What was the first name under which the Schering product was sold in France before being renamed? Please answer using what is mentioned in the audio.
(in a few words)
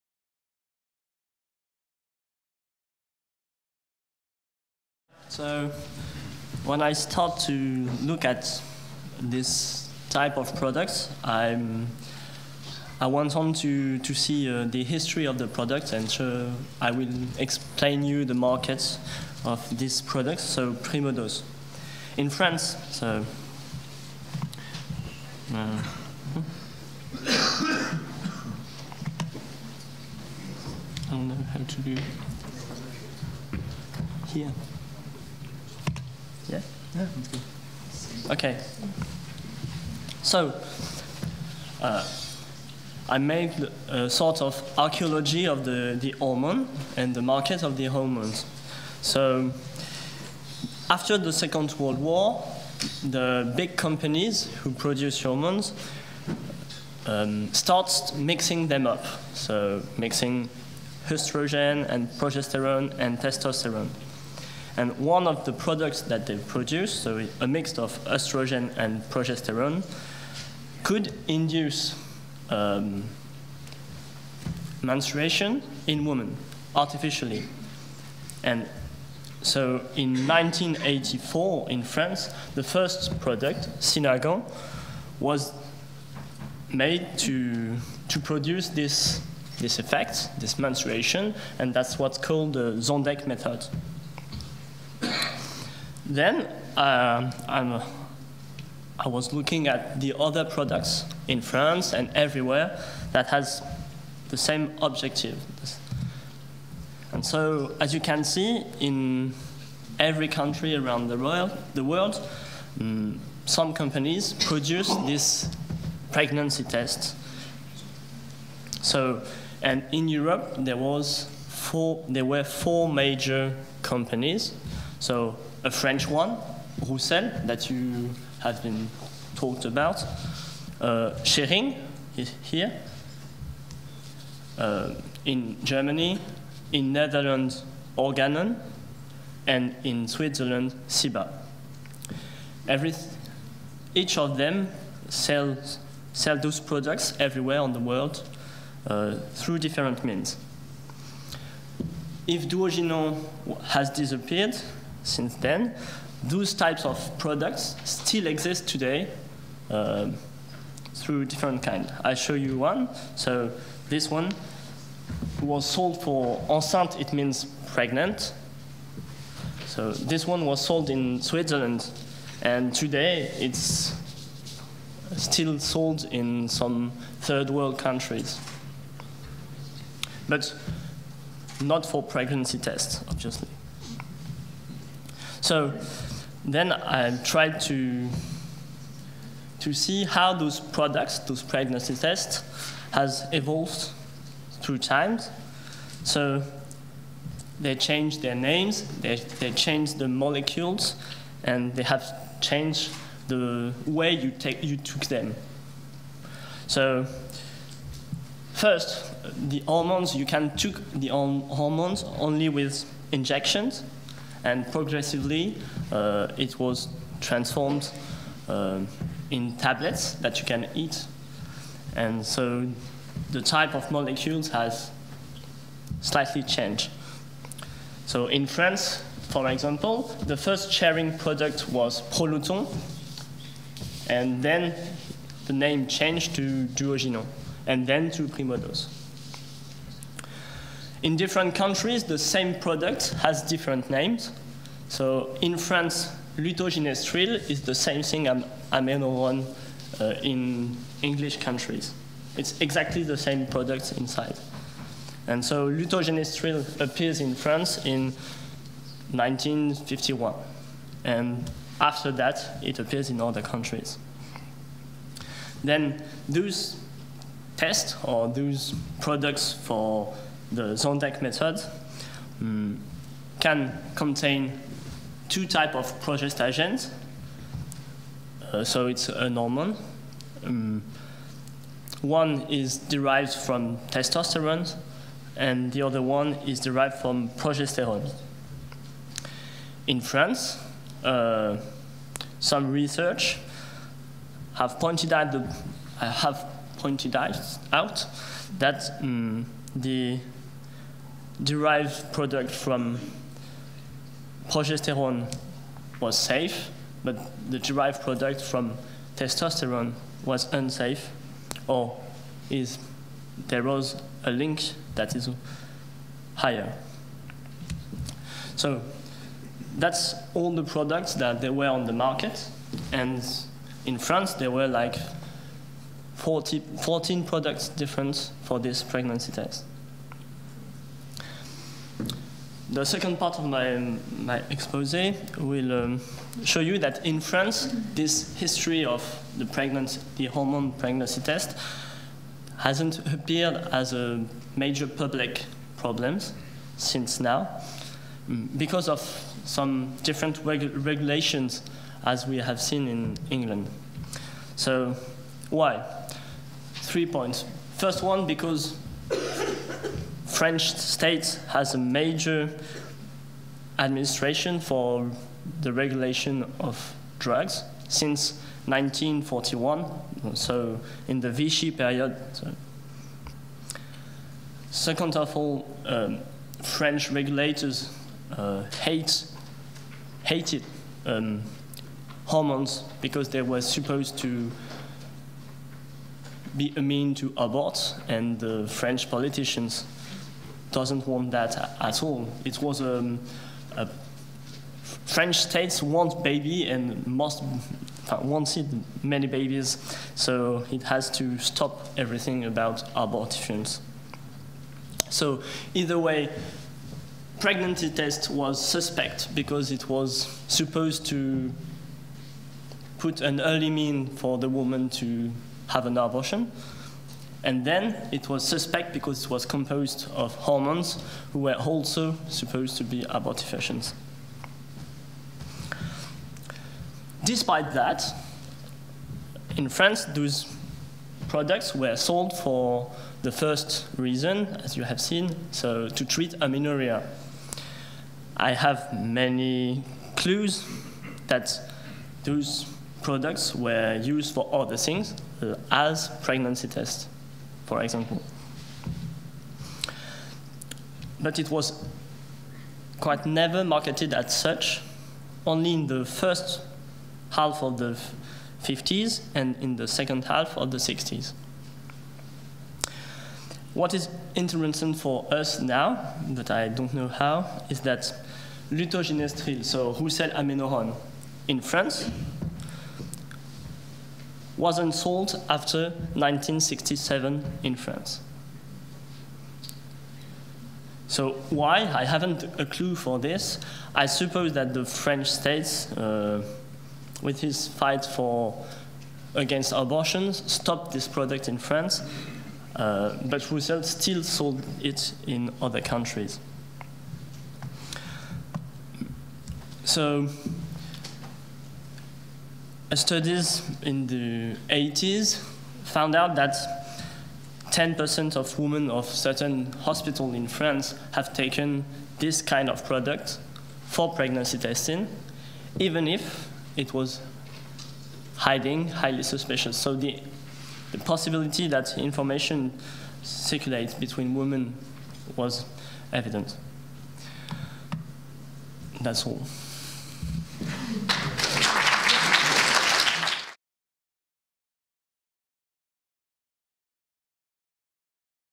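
Proluton.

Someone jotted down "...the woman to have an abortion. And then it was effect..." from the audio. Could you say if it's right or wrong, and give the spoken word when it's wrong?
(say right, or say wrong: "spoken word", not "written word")
wrong: "suspect", not "effect".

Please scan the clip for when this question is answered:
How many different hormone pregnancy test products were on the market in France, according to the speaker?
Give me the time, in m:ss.
5:26.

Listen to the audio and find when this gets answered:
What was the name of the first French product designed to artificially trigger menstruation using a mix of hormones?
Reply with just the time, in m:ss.
1:23.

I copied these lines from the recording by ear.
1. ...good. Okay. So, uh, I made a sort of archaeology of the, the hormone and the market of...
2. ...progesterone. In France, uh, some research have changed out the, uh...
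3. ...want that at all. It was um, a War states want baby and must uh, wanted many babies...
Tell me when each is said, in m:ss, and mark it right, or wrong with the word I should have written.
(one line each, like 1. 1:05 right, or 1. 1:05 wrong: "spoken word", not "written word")
1. 0:37 right
2. 4:47 wrong: "pointed", not "changed"
3. 6:31 wrong: "French", not "War".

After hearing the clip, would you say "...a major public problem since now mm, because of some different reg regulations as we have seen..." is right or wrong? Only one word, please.
right.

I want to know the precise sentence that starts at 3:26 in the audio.
So first, the hormones, you can take the hormones only with injections.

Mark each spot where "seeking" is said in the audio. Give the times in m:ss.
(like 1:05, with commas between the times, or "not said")
not said.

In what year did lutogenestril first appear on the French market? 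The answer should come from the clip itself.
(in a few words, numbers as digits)
1951.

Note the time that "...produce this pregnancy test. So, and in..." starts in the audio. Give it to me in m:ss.
1:54.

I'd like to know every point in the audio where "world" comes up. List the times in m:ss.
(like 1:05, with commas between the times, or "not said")
0:51, 1:51, 2:27, 2:57.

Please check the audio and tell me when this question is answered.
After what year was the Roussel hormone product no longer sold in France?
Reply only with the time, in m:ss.
7:56.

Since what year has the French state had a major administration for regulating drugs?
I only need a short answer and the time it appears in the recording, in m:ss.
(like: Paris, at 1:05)
1941, at 6:08.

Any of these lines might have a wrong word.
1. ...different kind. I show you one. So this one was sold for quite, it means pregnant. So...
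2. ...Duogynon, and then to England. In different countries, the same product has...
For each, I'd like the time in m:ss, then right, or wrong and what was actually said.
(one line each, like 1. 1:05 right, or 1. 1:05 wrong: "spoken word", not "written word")
1. 2:41 wrong: "enceinte", not "quite"
2. 3:56 wrong: "Primodos", not "England".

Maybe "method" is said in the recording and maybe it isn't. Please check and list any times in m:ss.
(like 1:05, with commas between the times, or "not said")
1:33, 4:31.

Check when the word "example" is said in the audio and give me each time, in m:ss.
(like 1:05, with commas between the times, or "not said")
3:49, 7:27.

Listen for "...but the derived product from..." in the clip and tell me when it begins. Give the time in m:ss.
5:07.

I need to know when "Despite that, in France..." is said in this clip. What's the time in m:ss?
7:07.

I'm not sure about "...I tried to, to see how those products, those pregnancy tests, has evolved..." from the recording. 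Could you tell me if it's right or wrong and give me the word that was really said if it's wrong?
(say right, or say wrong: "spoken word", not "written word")
right.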